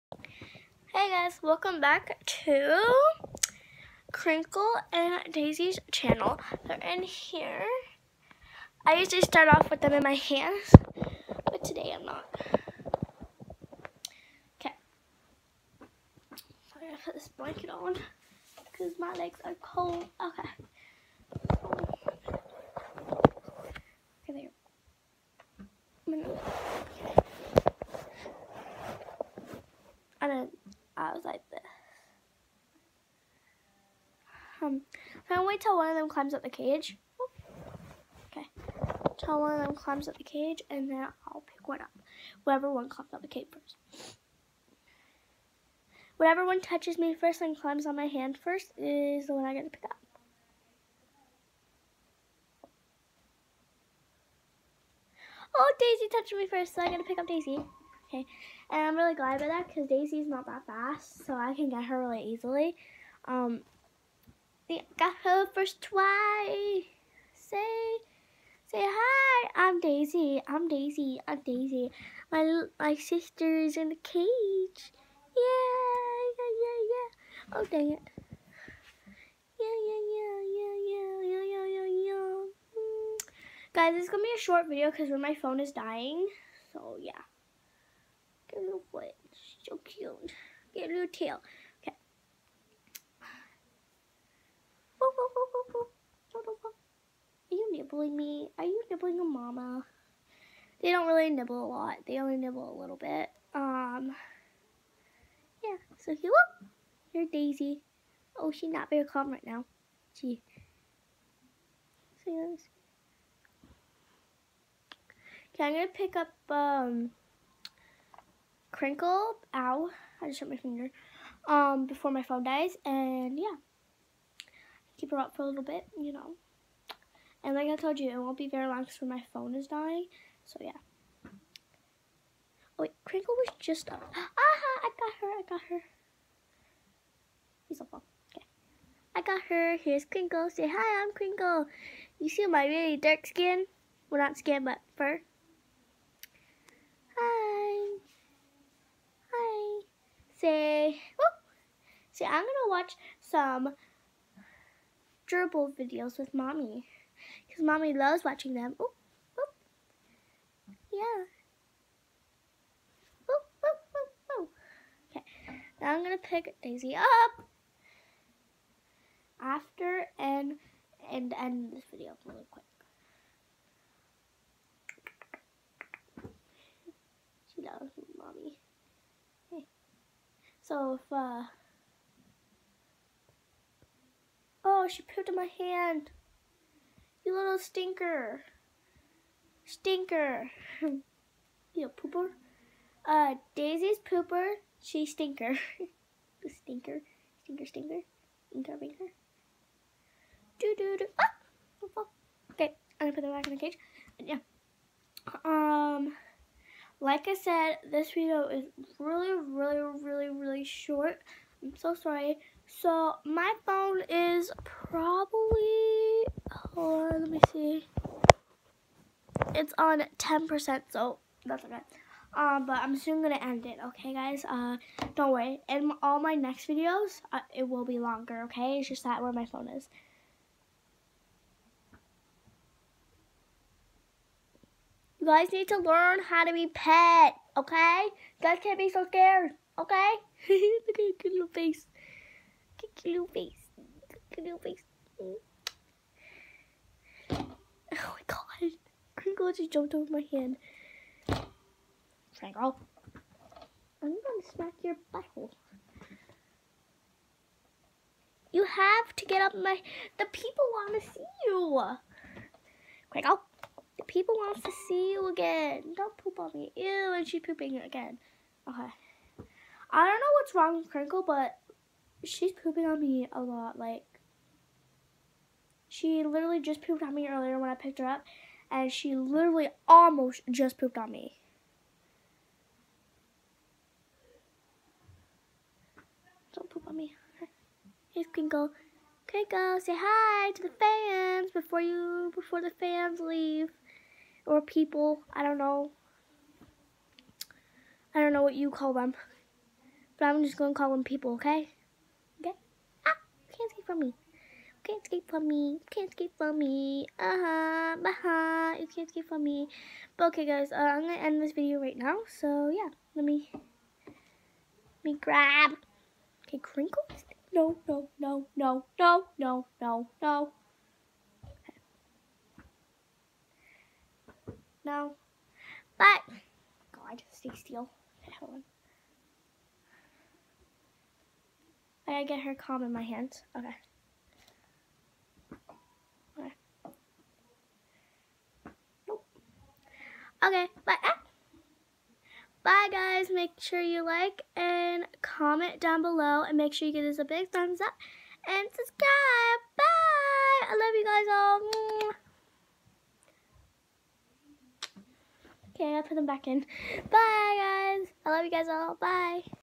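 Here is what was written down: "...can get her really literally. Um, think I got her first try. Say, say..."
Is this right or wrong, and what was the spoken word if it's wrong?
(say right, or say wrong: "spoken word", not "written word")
wrong: "easily", not "literally".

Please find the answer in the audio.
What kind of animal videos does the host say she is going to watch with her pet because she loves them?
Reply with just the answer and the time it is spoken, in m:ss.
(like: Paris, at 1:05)
Gerbil videos, at 2:35.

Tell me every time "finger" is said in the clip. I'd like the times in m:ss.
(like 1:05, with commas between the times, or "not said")
2:00.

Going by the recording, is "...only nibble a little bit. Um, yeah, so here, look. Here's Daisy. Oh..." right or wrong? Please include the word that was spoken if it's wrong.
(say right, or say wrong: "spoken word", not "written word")
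right.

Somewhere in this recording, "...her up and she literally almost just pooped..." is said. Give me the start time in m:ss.
4:37.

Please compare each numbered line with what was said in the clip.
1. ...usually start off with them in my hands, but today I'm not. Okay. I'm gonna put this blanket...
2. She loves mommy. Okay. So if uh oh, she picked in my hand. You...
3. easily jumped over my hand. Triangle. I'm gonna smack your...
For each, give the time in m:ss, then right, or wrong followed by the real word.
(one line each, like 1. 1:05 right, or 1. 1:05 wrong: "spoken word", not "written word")
1. 0:08 right
2. 2:57 wrong: "pooped", not "picked"
3. 4:09 wrong: "literally", not "easily".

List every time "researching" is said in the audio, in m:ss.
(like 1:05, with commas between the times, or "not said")
not said.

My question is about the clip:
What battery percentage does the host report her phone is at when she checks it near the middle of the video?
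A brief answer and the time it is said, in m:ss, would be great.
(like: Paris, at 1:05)
10%, at 3:40.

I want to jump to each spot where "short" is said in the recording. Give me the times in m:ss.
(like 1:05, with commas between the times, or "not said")
1:24, 3:30.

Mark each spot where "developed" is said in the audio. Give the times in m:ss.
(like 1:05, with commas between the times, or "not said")
not said.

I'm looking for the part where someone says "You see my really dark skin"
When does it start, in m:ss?
2:22.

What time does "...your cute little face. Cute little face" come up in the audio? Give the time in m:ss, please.
4:00.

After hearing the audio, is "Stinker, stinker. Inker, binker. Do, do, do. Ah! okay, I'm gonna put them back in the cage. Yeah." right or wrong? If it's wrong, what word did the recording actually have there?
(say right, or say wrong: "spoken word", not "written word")
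right.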